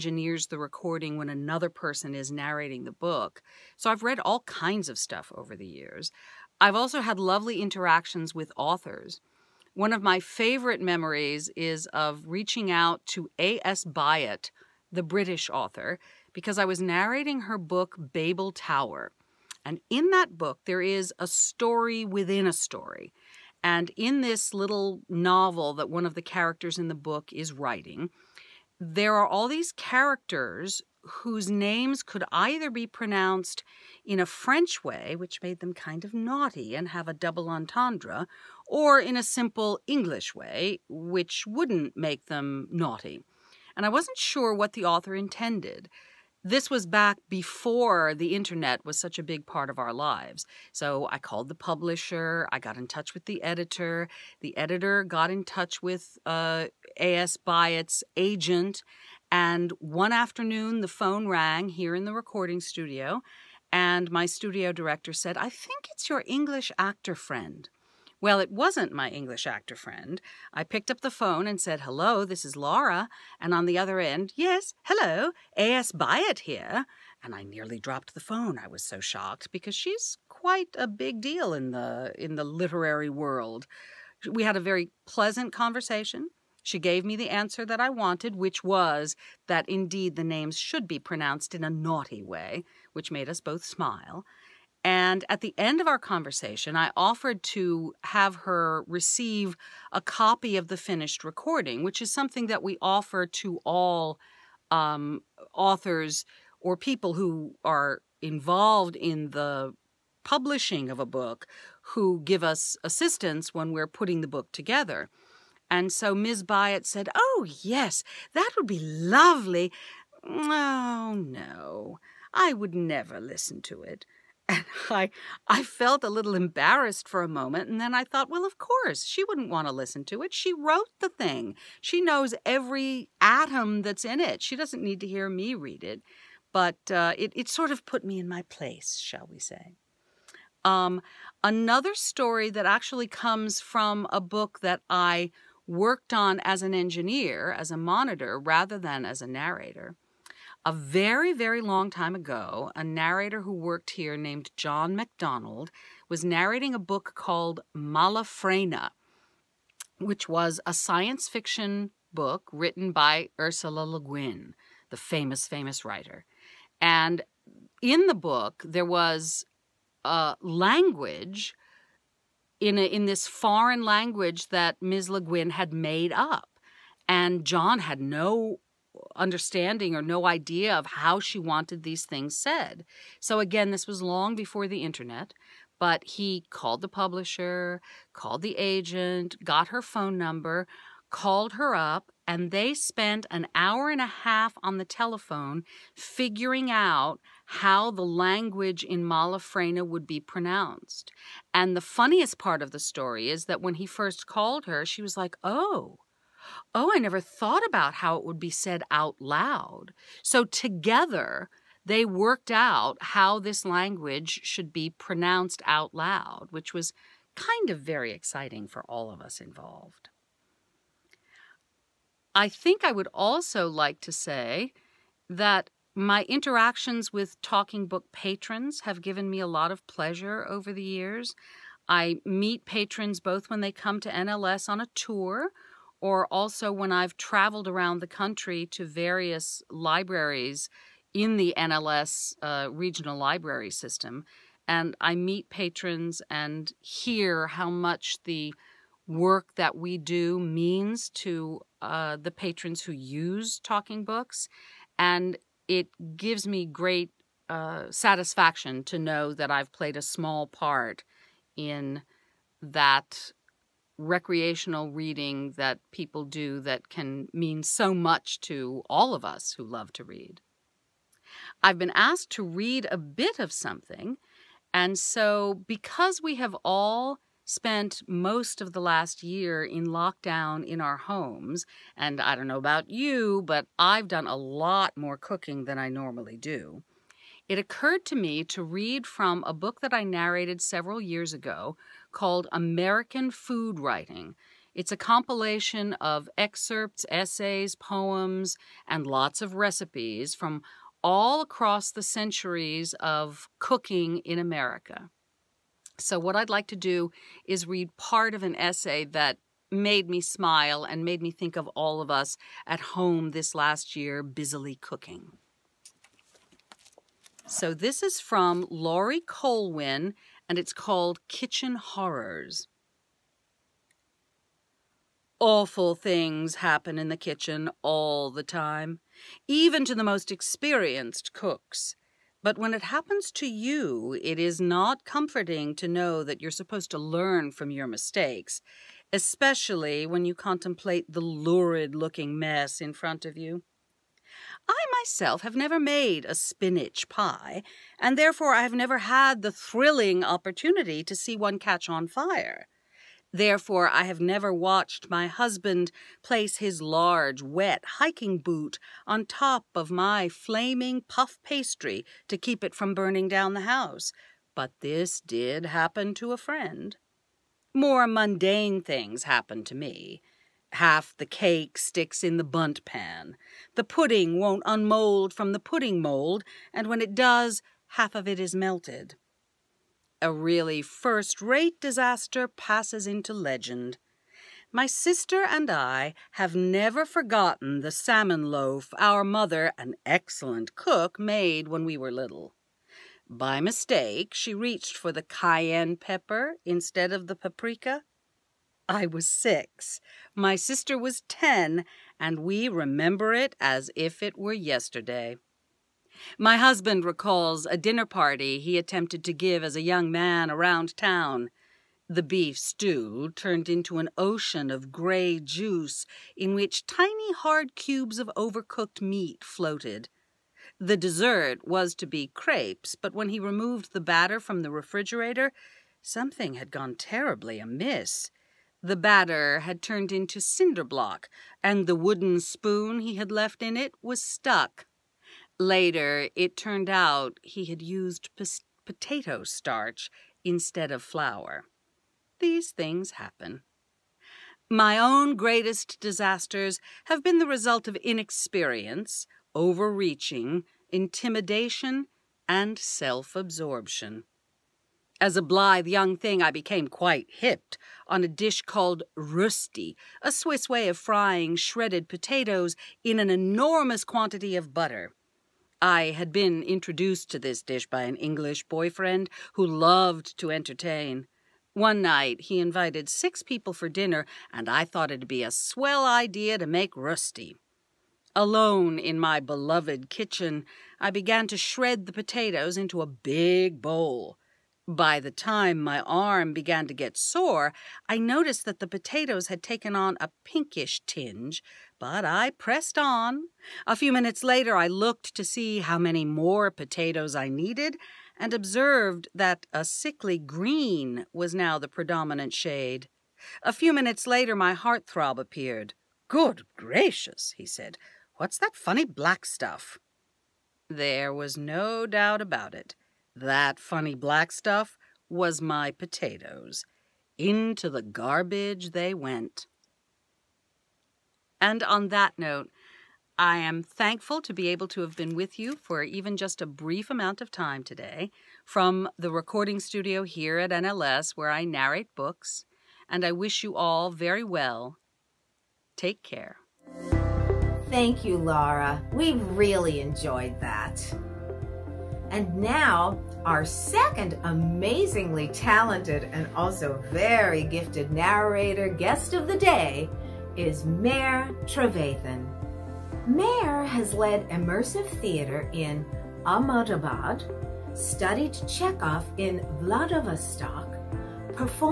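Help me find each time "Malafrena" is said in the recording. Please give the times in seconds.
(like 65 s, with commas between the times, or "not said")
157 s, 199 s.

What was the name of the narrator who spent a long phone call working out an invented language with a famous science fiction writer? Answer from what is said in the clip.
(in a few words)
John MacDonald.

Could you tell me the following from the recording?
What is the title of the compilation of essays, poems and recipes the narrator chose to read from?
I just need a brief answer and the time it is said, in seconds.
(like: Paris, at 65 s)
American Food Writing, at 292 s.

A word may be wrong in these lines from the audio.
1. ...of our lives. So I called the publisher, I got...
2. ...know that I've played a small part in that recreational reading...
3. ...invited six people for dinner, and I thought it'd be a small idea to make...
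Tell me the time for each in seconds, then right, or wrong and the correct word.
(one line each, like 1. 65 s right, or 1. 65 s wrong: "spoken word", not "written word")
1. 49 s right
2. 258 s right
3. 472 s wrong: "swell", not "small".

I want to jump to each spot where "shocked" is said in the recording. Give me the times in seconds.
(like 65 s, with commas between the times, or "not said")
78 s.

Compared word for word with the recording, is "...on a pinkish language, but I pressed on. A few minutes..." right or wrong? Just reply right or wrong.
wrong.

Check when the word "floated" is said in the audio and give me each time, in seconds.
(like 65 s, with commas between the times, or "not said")
419 s.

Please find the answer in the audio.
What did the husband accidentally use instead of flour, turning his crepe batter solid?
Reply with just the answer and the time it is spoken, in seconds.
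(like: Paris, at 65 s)
Potato starch, at 438 s.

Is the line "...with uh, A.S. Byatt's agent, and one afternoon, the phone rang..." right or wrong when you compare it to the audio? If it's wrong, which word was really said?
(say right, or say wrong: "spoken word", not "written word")
right.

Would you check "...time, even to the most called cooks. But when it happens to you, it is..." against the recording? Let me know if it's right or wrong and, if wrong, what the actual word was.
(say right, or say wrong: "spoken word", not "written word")
wrong: "experienced", not "called".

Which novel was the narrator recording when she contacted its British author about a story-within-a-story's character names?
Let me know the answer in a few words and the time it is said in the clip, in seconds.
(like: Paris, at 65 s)
Babel Tower, at 18 s.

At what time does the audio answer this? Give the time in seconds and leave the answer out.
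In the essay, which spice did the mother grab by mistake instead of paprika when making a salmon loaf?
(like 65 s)
395 s.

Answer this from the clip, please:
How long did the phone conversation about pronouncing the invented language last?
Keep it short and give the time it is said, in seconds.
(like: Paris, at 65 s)
An hour and a half, at 193 s.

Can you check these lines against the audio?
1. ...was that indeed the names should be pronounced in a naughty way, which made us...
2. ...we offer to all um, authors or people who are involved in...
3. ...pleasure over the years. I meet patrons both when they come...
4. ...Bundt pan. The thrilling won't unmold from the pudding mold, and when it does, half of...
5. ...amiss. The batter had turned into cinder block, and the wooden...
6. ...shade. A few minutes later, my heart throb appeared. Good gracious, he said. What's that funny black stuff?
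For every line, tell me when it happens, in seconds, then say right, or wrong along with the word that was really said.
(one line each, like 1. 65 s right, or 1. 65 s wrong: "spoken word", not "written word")
1. 88 s right
2. 102 s right
3. 229 s right
4. 372 s wrong: "pudding", not "thrilling"
5. 427 s right
6. 502 s right.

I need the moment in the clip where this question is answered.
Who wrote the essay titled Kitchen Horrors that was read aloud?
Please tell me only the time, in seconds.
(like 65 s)
318 s.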